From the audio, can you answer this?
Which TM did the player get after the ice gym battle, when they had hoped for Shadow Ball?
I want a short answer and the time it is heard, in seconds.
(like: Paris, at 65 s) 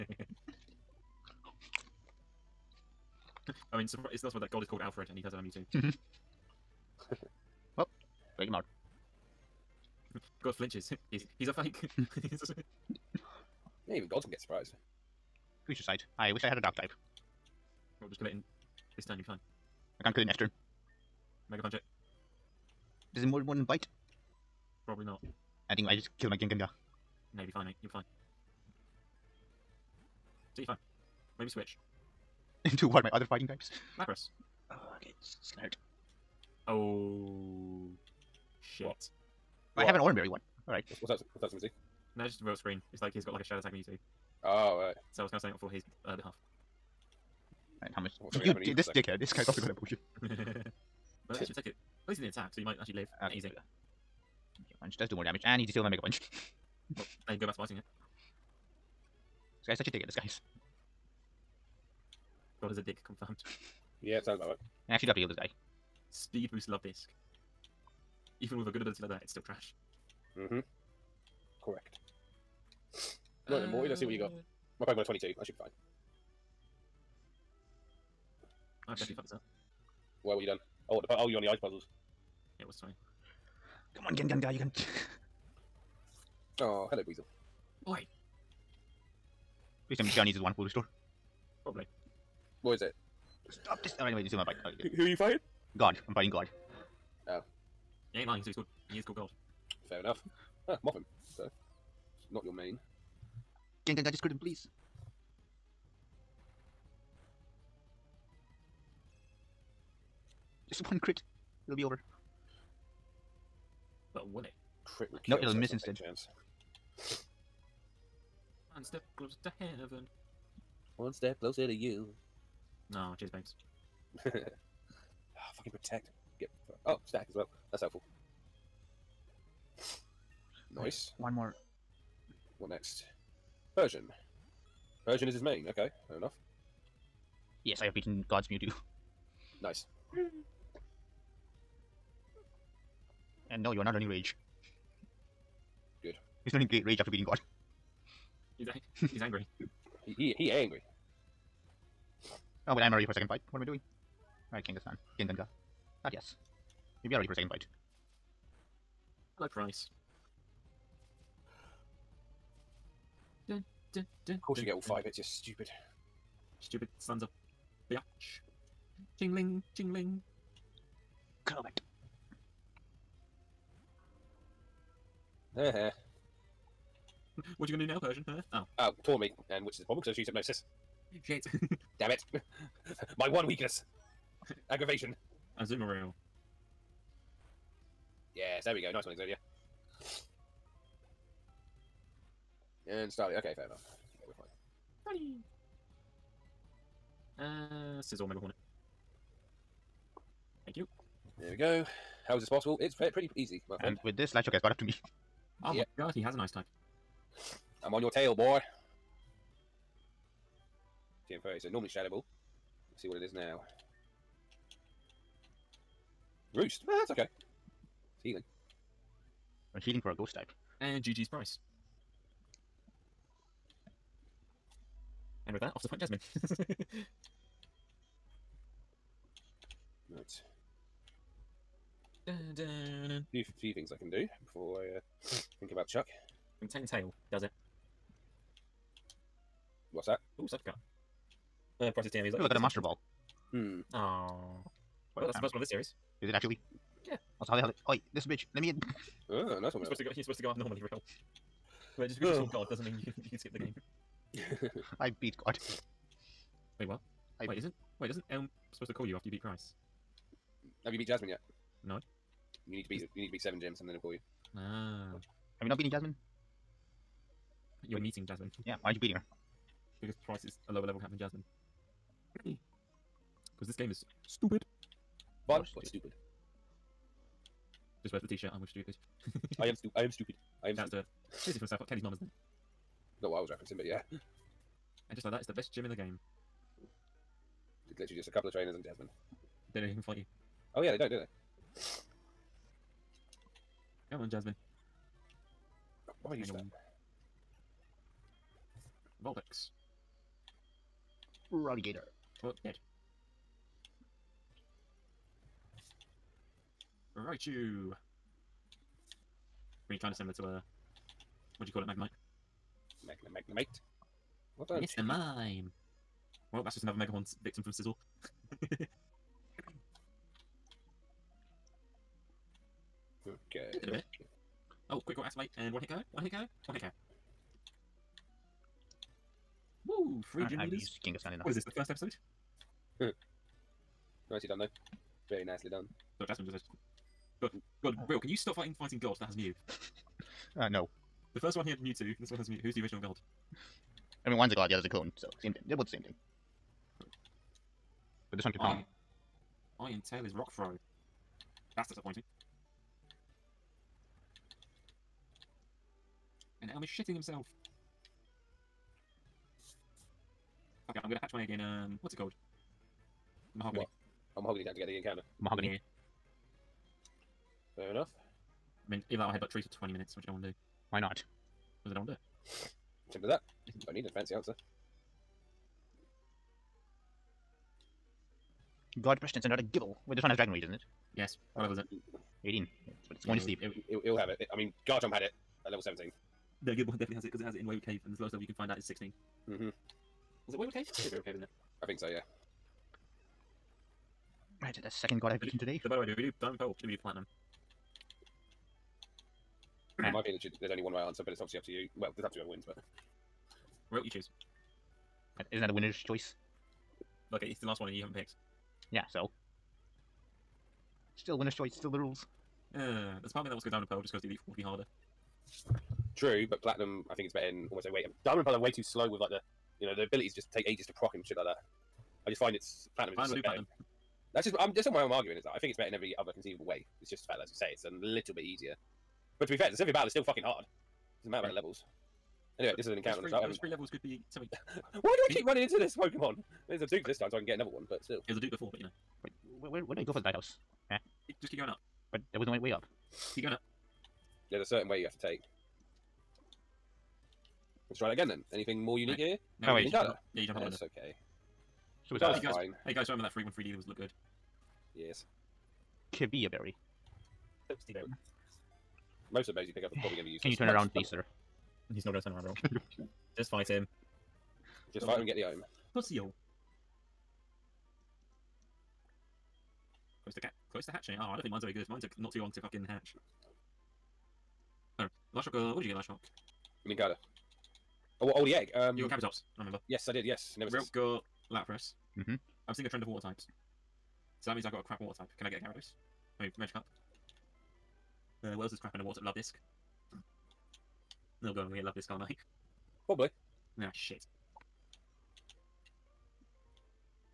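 Roost, at 216 s.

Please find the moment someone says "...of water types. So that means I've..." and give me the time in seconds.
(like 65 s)
483 s.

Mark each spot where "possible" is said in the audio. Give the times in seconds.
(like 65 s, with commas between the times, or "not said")
202 s.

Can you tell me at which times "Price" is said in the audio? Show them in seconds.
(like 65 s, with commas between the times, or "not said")
259 s, 270 s.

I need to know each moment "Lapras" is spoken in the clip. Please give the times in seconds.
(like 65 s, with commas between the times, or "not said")
33 s, 481 s.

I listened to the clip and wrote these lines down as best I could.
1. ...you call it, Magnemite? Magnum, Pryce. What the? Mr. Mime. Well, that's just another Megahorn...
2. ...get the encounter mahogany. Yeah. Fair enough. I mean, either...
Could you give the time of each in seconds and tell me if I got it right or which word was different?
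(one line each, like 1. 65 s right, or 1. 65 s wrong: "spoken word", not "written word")
1. 311 s wrong: "Magnemite", not "Pryce"
2. 364 s right.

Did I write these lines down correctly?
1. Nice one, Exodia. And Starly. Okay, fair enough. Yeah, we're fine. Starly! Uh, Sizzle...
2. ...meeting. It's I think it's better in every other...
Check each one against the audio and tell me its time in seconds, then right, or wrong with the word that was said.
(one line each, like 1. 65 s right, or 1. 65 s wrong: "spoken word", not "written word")
1. 188 s right
2. 425 s wrong: "arguing", not "meeting".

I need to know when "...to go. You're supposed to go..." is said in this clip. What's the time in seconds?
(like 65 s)
249 s.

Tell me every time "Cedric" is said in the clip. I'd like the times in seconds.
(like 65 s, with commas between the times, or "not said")
not said.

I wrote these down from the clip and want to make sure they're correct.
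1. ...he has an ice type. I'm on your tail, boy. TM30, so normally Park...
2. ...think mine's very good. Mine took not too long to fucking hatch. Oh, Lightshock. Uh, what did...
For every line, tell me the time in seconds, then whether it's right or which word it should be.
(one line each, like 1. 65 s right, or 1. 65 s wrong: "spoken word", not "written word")
1. 206 s wrong: "Shadow", not "Park"
2. 471 s right.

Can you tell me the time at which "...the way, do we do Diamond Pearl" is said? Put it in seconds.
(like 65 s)
395 s.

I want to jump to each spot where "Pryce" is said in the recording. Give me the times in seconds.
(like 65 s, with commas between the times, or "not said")
159 s, 221 s, 241 s.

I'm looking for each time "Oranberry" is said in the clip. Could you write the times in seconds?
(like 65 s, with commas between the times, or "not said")
39 s.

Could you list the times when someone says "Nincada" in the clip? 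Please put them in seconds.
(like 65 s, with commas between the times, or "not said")
449 s, 476 s.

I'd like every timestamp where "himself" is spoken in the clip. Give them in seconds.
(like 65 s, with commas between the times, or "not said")
357 s.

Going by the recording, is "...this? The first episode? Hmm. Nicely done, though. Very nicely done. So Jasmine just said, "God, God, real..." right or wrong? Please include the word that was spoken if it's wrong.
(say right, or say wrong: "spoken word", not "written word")
right.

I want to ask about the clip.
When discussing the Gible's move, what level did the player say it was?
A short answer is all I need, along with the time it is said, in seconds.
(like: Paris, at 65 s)
18, at 382 s.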